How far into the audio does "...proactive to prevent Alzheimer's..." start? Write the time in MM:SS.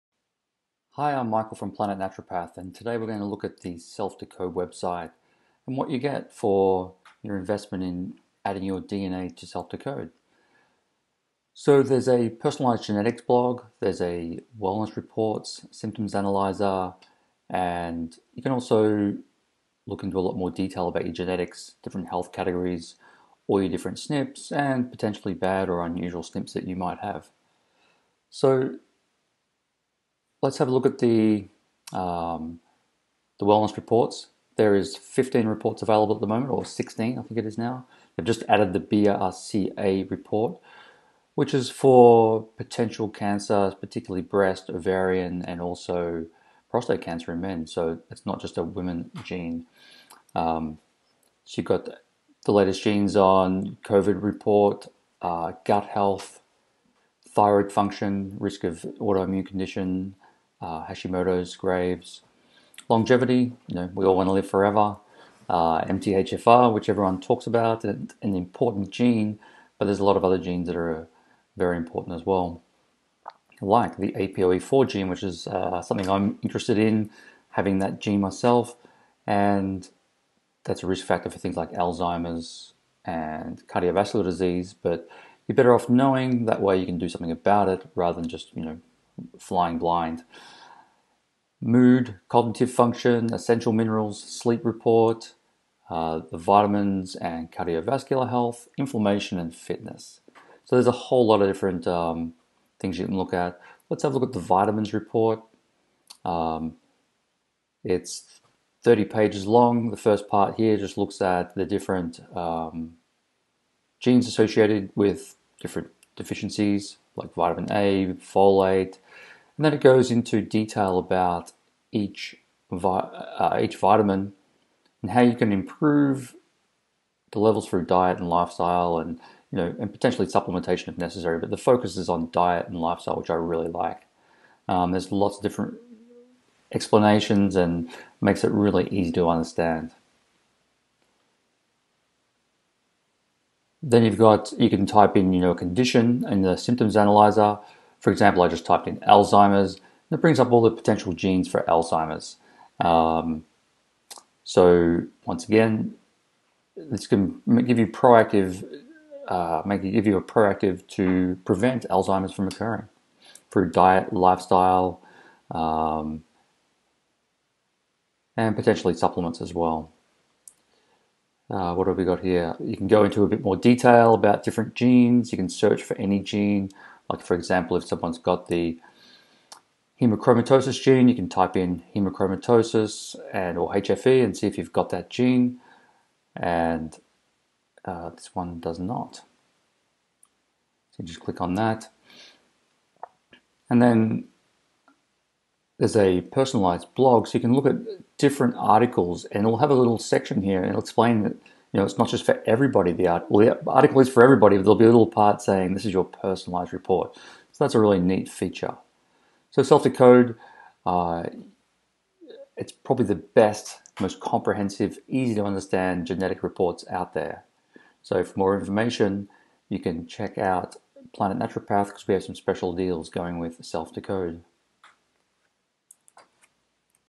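02:40.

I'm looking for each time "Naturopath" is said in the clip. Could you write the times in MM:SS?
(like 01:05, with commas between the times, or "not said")
00:01, 03:41.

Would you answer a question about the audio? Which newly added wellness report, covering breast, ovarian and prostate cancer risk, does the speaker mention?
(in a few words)
BRCA report.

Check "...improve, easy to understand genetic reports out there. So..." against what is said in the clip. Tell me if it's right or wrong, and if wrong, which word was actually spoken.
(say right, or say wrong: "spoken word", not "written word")
wrong: "comprehensive", not "improve".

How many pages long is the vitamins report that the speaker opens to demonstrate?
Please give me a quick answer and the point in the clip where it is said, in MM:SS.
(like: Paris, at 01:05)
30 pages, at 01:48.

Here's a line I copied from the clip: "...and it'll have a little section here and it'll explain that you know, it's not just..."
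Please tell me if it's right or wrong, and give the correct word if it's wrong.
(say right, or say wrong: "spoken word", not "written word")
right.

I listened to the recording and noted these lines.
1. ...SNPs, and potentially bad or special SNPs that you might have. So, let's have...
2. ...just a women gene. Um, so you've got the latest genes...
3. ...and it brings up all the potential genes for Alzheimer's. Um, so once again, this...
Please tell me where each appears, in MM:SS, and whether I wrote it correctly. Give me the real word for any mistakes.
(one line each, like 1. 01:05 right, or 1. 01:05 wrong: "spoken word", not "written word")
1. 00:23 wrong: "unusual", not "special"
2. 00:48 right
3. 02:29 right.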